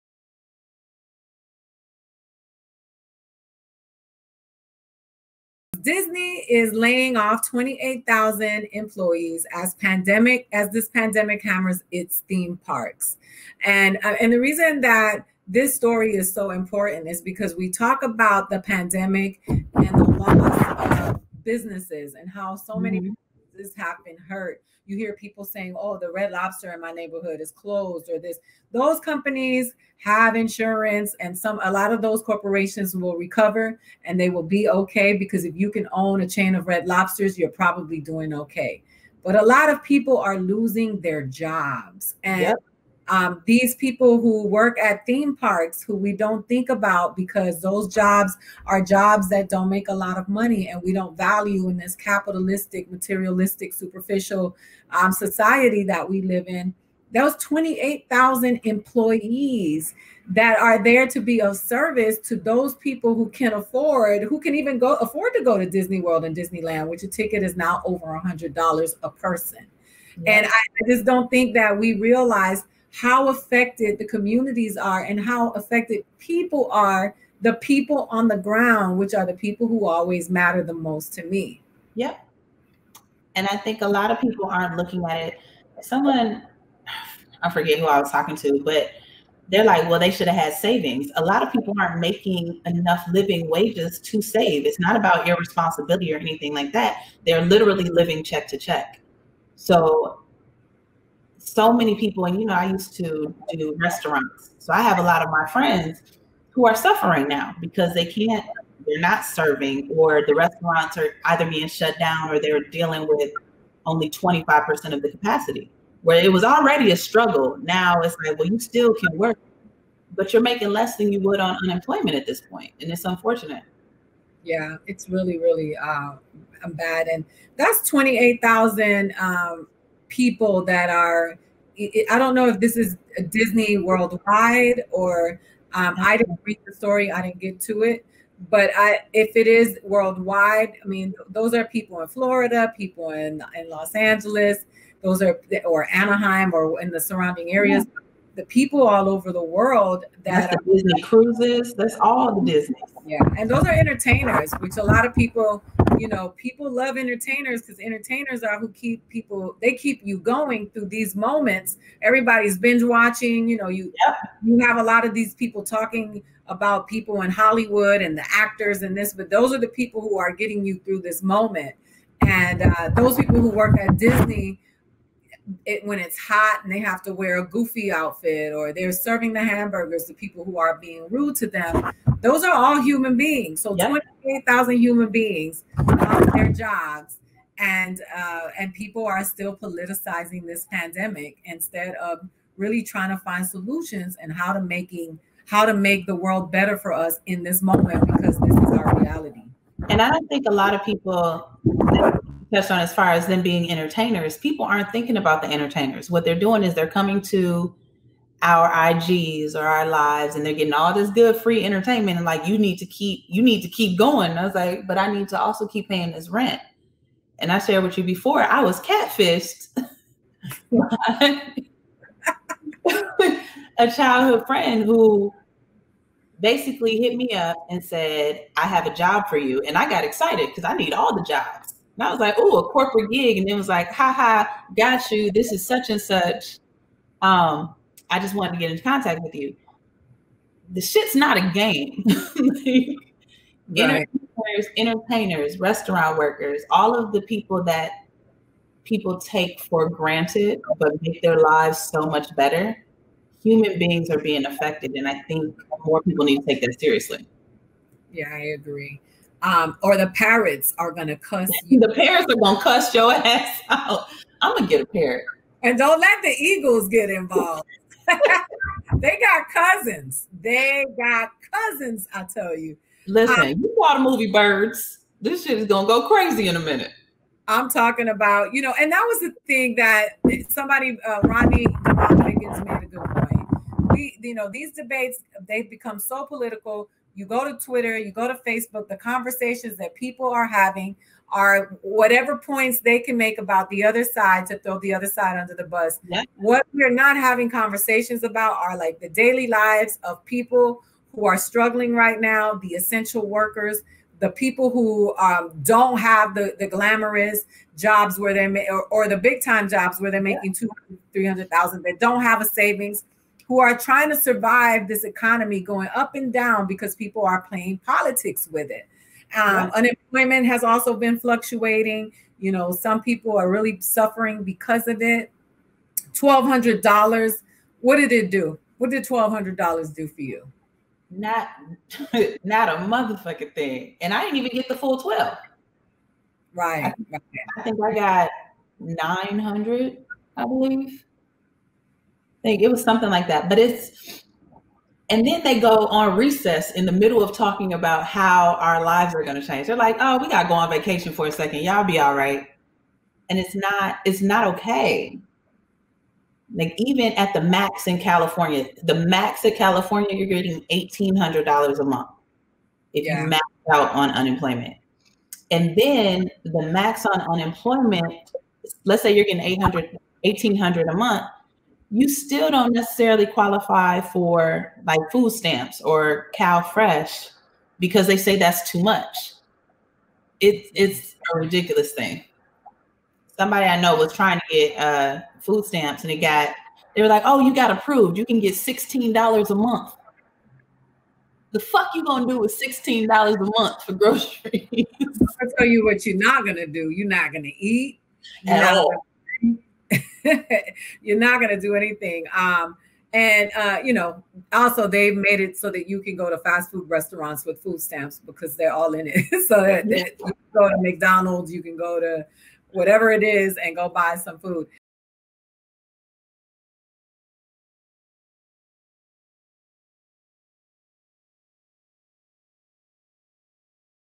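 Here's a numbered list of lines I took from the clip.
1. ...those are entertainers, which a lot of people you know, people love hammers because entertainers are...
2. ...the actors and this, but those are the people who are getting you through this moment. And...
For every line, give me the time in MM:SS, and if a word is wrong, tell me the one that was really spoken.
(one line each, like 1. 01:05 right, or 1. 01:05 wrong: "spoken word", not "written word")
1. 02:33 wrong: "entertainers", not "hammers"
2. 02:48 right.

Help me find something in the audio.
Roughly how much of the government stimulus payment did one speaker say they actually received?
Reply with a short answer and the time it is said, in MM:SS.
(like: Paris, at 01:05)
$900, at 05:38.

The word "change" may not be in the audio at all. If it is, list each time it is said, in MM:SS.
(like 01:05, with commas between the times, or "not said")
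05:49.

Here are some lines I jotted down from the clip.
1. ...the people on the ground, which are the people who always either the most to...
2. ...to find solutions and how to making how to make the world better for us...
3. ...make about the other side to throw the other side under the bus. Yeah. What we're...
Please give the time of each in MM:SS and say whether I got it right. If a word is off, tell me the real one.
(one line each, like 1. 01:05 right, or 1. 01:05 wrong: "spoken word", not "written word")
1. 01:17 wrong: "matter", not "either"
2. 03:13 right
3. 04:53 right.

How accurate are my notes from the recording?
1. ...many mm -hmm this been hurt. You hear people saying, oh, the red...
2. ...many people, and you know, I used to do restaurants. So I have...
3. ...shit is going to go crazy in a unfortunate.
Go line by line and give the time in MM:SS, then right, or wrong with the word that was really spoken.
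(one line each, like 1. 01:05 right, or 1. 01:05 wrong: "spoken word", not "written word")
1. 00:22 right
2. 01:41 right
3. 04:35 wrong: "minute", not "unfortunate".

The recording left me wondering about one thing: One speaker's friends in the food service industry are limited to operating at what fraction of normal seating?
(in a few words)
25%.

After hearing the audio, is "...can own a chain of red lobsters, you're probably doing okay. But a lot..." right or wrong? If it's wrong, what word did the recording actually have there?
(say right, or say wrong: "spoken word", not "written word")
right.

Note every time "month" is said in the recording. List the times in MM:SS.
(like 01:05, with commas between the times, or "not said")
06:01, 06:10, 06:29, 06:33.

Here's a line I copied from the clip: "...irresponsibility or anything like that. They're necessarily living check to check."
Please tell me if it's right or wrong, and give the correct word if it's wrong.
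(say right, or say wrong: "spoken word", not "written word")
wrong: "literally", not "necessarily".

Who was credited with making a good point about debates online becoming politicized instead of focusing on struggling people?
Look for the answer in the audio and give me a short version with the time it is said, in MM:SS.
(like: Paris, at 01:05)
Rodney Higgins, at 04:41.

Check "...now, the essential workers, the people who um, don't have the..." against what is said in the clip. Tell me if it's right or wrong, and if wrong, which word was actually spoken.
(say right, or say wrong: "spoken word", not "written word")
right.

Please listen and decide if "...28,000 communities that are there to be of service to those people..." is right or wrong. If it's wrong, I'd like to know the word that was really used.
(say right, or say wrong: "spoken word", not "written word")
wrong: "employees", not "communities".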